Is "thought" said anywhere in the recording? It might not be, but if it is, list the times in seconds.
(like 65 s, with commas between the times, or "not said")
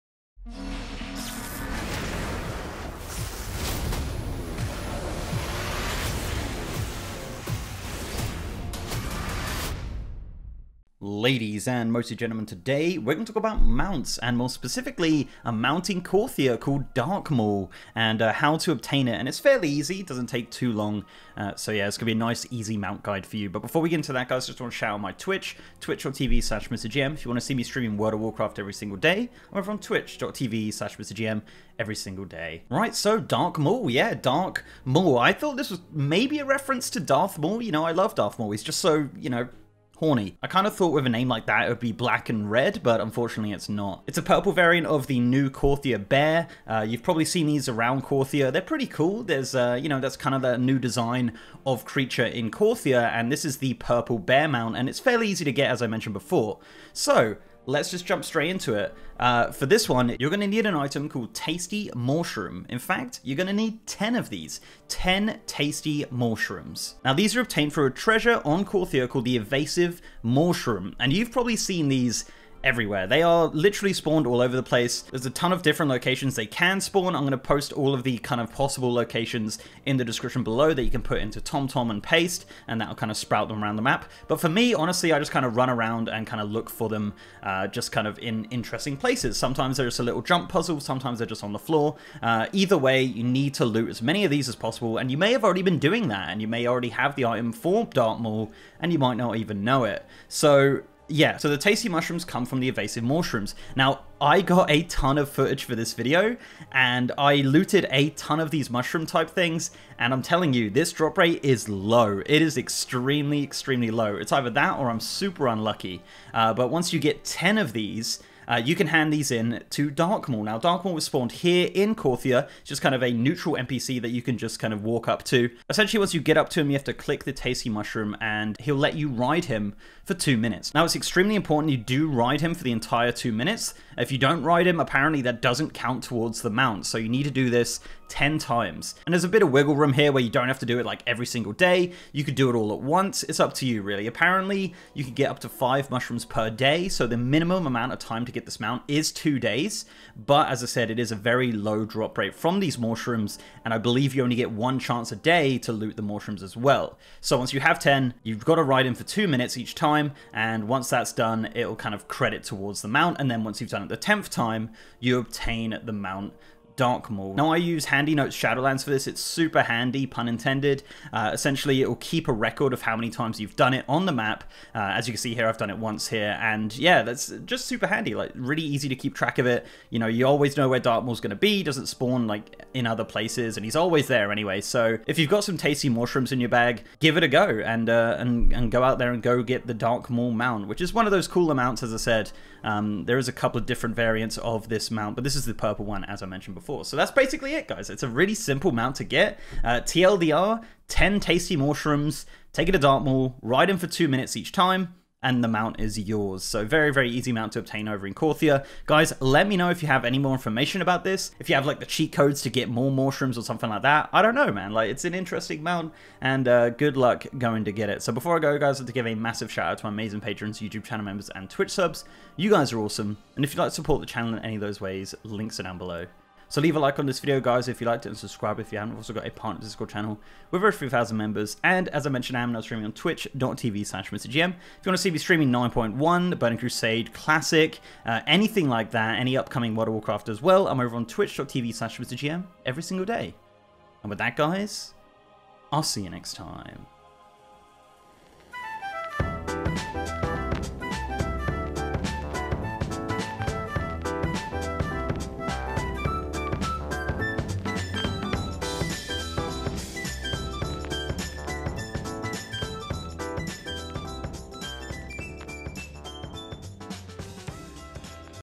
35 s, 40 s.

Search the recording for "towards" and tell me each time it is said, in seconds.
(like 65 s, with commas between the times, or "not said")
136 s, 162 s.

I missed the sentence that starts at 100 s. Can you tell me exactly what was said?
So yeah, so the tasty mawshrooms come from the invasive mawshrooms.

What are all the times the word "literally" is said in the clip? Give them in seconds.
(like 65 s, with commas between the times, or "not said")
73 s.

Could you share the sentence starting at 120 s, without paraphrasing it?
Now, Darkmaul was spawned here in It's just kind of a neutral NPC that you can just kind of walk up to.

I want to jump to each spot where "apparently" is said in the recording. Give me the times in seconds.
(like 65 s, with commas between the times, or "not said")
134 s, 144 s.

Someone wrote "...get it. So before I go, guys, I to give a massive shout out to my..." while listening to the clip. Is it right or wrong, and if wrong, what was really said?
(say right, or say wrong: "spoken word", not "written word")
right.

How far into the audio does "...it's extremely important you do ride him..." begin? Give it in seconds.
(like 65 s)
130 s.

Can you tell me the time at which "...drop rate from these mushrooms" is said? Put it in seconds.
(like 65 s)
151 s.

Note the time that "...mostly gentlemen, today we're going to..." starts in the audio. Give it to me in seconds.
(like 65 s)
11 s.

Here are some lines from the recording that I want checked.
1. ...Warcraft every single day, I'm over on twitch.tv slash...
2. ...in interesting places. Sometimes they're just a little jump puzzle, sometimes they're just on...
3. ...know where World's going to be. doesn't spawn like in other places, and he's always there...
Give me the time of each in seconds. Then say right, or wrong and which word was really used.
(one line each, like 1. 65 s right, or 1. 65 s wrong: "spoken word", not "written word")
1. 28 s right
2. 88 s right
3. 180 s wrong: "Darkmaul", not "World".